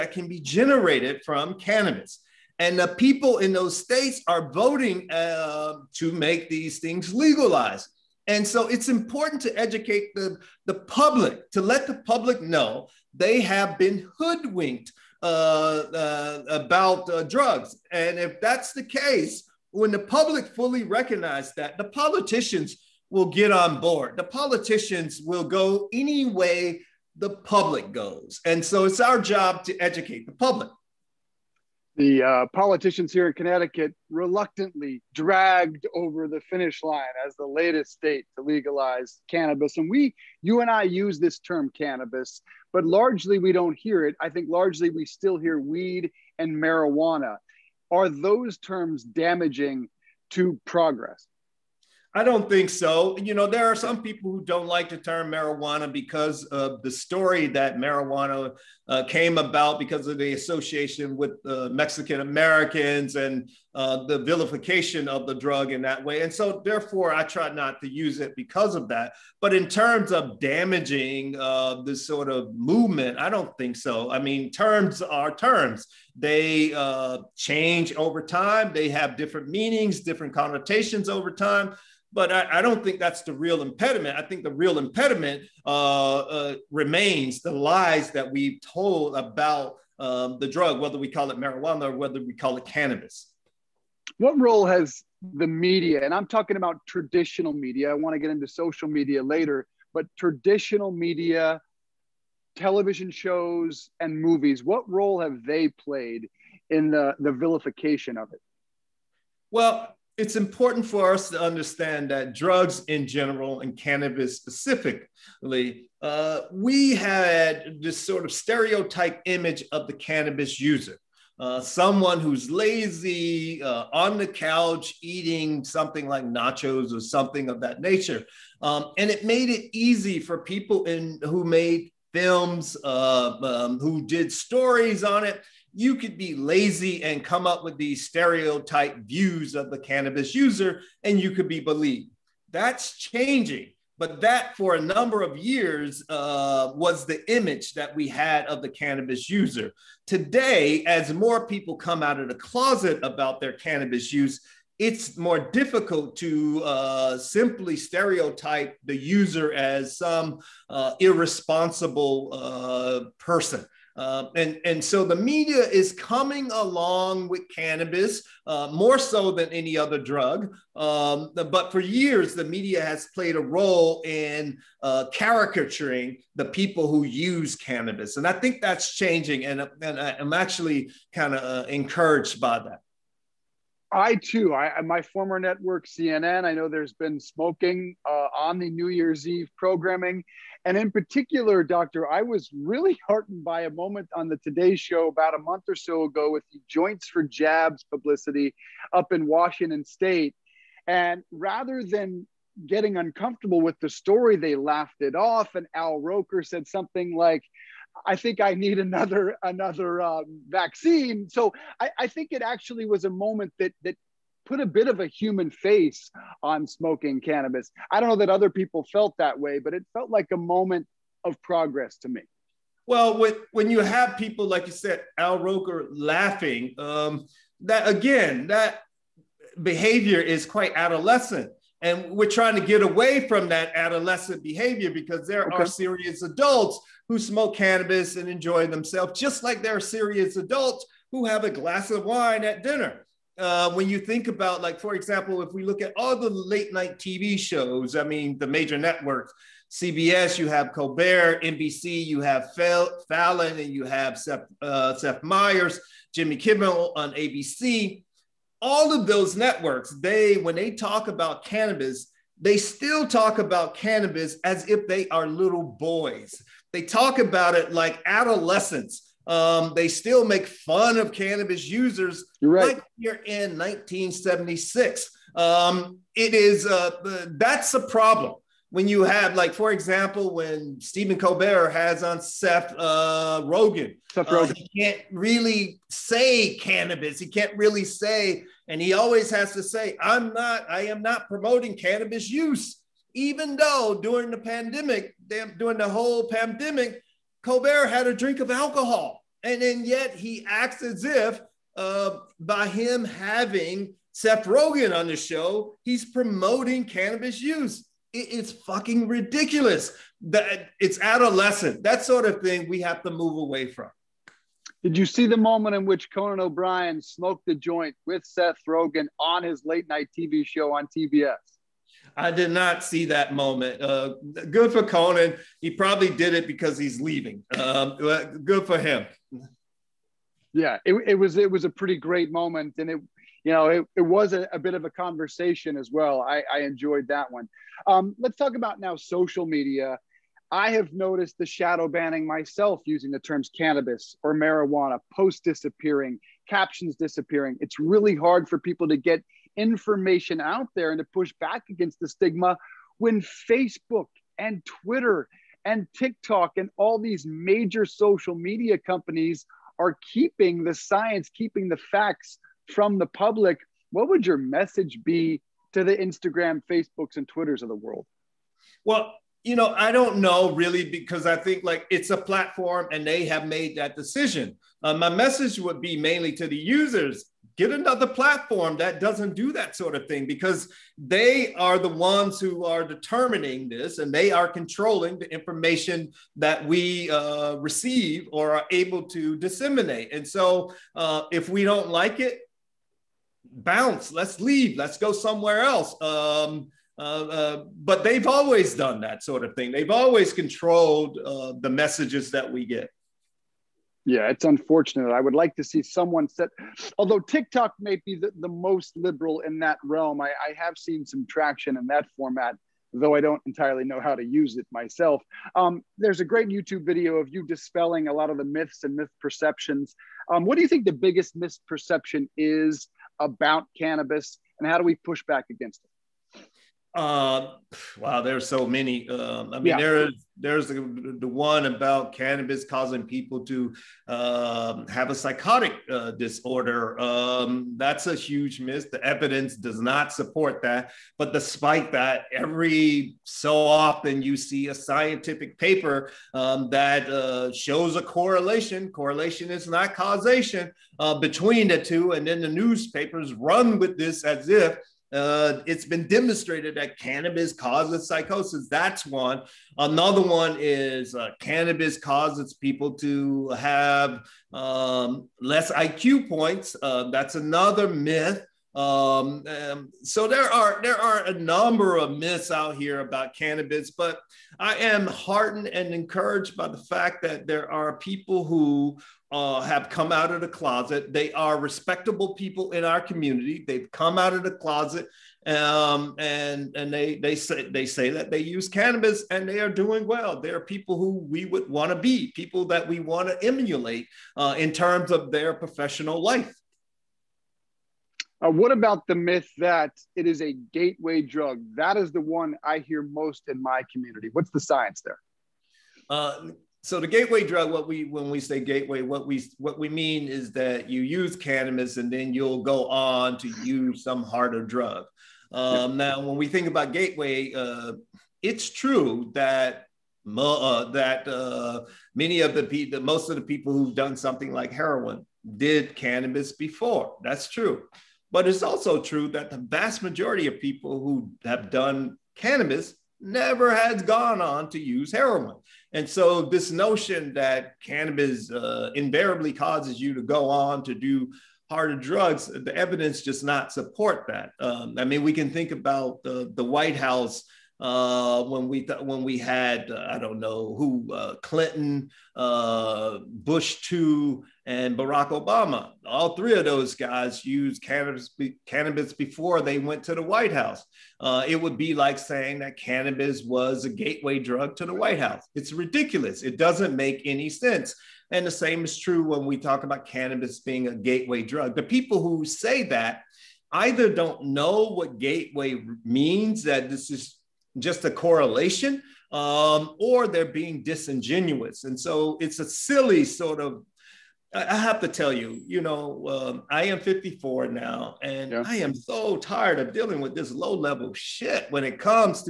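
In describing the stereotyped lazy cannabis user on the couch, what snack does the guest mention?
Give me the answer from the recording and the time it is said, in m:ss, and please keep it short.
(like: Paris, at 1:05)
nachos, at 2:06.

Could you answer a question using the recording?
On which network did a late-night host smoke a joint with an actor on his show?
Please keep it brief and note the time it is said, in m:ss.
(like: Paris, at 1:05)
TBS, at 5:20.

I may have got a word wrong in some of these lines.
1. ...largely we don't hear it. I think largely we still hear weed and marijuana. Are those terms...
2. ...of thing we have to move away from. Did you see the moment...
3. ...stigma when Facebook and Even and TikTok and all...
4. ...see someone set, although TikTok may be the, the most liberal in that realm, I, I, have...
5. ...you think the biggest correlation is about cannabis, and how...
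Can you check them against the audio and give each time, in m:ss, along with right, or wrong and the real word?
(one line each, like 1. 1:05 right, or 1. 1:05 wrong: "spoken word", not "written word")
1. 0:42 right
2. 5:12 right
3. 5:52 wrong: "Twitter", not "Even"
4. 6:45 right
5. 7:00 wrong: "misperception", not "correlation".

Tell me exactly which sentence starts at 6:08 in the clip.
Well, you know, I don't know really because I think like it's a platform and they have made that decision.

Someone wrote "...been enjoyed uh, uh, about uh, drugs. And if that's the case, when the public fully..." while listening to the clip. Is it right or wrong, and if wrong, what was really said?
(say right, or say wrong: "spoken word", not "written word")
wrong: "hoodwinked", not "enjoyed".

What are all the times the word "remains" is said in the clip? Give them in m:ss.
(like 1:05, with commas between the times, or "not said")
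1:26.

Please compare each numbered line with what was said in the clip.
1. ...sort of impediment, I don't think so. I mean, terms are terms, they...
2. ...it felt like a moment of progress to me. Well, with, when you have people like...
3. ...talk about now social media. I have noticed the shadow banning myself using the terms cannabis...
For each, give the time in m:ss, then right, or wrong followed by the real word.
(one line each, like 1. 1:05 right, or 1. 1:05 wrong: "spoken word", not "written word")
1. 1:12 wrong: "movement", not "impediment"
2. 3:39 right
3. 5:38 right.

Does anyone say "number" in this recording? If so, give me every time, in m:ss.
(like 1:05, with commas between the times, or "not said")
2:24, 7:51.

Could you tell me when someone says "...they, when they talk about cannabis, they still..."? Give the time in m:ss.
4:20.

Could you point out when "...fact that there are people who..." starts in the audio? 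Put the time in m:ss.
7:56.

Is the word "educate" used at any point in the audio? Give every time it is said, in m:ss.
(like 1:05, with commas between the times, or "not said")
0:09, 0:29.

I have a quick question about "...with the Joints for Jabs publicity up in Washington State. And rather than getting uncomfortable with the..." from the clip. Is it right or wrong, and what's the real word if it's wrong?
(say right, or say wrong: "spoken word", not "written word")
right.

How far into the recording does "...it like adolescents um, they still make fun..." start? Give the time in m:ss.
4:27.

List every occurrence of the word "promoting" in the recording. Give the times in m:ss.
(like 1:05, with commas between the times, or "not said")
4:51, 5:06.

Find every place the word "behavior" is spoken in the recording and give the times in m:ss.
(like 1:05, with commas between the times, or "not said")
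3:49, 3:54.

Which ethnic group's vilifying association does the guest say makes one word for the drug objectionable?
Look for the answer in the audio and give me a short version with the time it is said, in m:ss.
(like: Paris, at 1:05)
Mexican Americans, at 1:01.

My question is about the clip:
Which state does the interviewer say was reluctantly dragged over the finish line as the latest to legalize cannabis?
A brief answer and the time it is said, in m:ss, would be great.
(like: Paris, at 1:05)
Connecticut, at 0:33.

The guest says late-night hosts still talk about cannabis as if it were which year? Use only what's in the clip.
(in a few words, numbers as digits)
1976.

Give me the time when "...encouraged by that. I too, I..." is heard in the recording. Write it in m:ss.
3:01.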